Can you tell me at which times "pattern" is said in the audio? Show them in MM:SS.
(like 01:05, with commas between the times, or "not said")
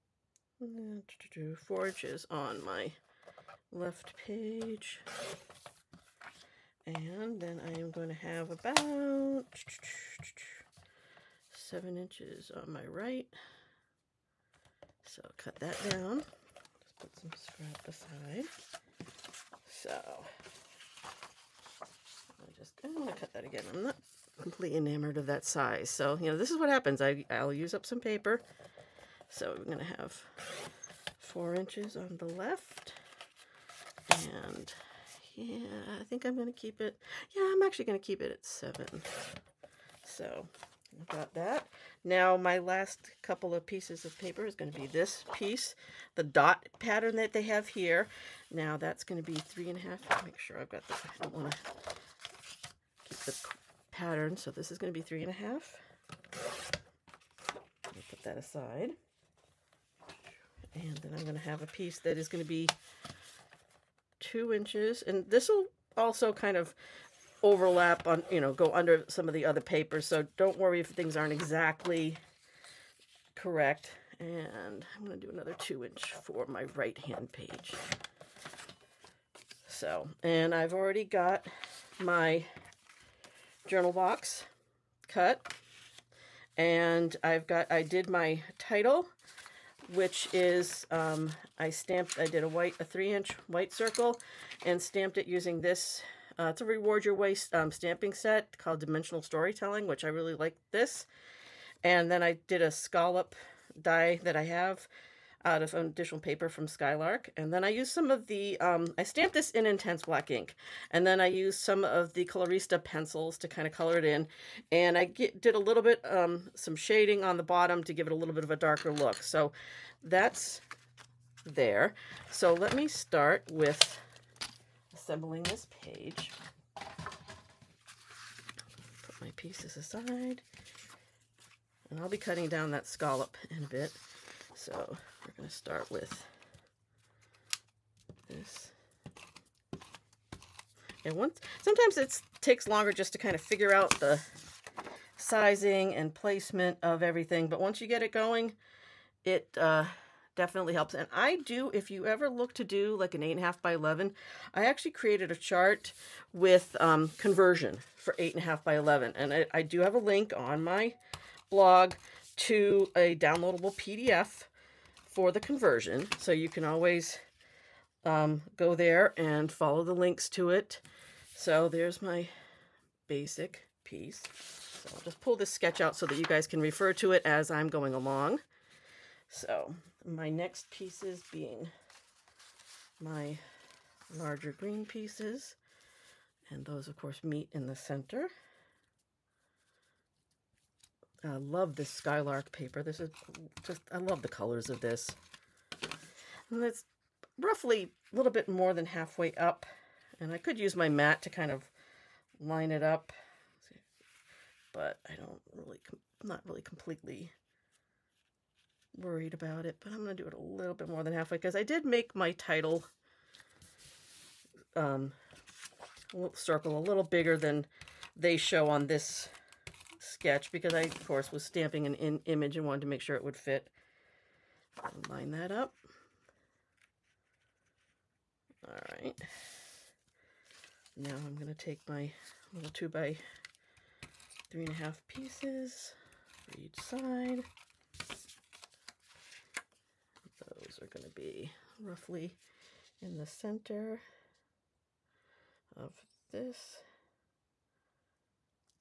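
00:46, 00:53.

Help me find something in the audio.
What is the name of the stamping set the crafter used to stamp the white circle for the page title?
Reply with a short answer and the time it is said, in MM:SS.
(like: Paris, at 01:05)
Dimensional Storytelling, at 01:38.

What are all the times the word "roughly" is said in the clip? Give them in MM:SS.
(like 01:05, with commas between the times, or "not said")
03:17, 04:01.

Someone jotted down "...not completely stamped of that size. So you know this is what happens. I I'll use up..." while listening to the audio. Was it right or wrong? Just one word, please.
wrong.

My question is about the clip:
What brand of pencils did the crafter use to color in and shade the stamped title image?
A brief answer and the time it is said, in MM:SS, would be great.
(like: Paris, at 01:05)
Colorista, at 01:52.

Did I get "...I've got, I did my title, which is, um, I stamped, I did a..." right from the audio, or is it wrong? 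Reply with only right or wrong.
right.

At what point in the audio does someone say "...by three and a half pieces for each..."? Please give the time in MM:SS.
03:52.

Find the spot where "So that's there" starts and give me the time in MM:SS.
01:59.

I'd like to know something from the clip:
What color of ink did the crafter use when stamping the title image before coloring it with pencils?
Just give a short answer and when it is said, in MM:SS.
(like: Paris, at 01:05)
intense black, at 01:49.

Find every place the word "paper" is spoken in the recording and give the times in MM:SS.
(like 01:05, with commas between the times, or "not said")
00:27, 00:44, 01:09, 01:46, 03:12.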